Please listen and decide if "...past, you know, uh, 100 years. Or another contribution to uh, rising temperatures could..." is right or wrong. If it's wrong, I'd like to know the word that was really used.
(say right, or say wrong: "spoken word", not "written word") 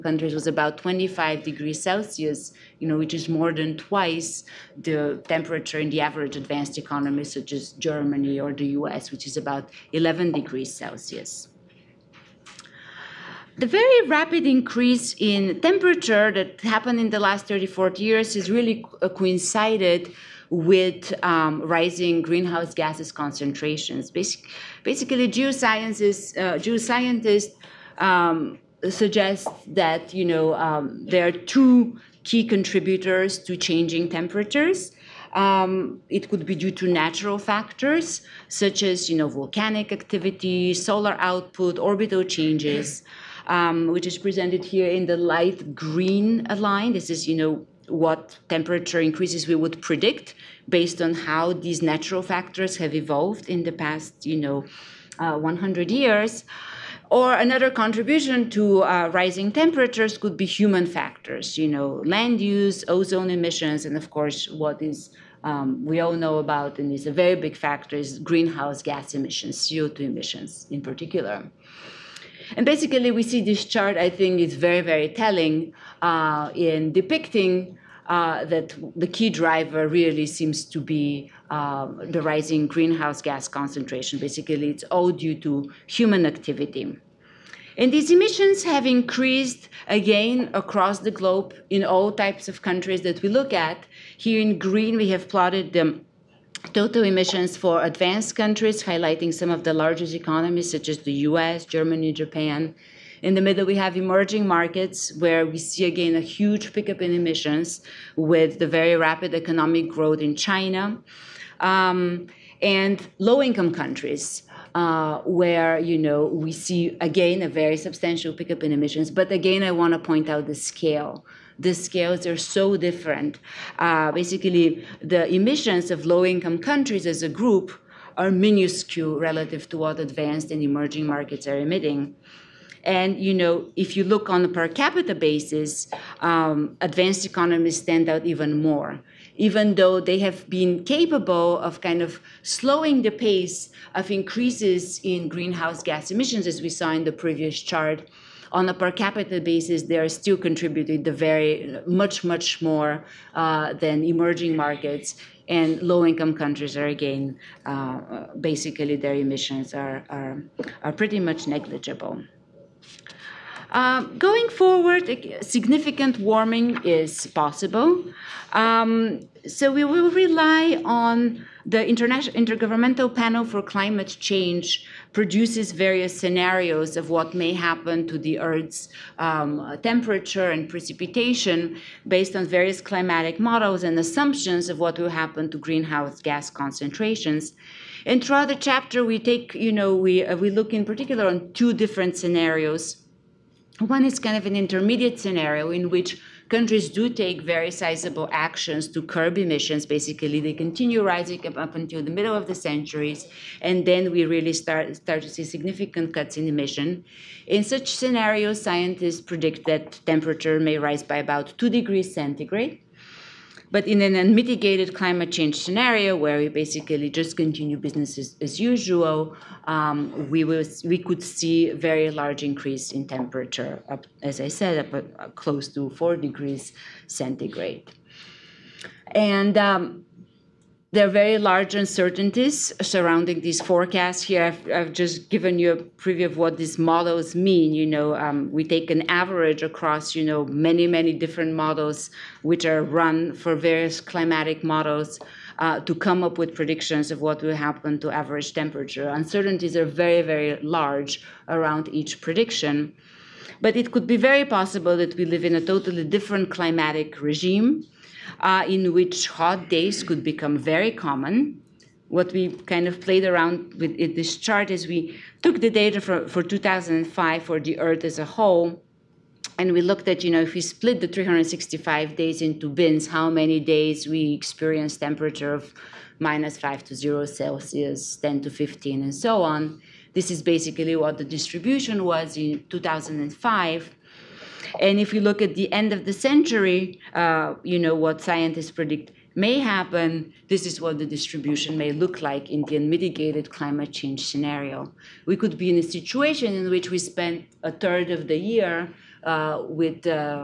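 right.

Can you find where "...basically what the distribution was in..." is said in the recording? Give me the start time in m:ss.
4:40.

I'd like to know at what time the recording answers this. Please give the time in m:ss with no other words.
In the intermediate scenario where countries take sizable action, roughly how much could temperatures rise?
3:31.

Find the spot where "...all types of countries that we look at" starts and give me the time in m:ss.
1:31.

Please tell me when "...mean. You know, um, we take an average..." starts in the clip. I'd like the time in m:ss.
3:57.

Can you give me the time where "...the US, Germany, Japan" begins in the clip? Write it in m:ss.
1:40.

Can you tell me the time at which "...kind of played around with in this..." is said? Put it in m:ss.
4:22.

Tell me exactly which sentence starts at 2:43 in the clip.
Um, going forward, significant warming is possible.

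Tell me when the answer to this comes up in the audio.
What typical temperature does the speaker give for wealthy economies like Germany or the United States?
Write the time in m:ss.
0:09.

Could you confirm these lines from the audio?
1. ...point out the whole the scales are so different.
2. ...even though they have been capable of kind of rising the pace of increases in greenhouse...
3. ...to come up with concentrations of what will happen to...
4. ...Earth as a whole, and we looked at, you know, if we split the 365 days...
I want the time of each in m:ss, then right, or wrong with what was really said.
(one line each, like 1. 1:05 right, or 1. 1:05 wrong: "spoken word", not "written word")
1. 1:59 wrong: "scale", not "whole"
2. 2:19 wrong: "slowing", not "rising"
3. 4:05 wrong: "predictions", not "concentrations"
4. 4:27 right.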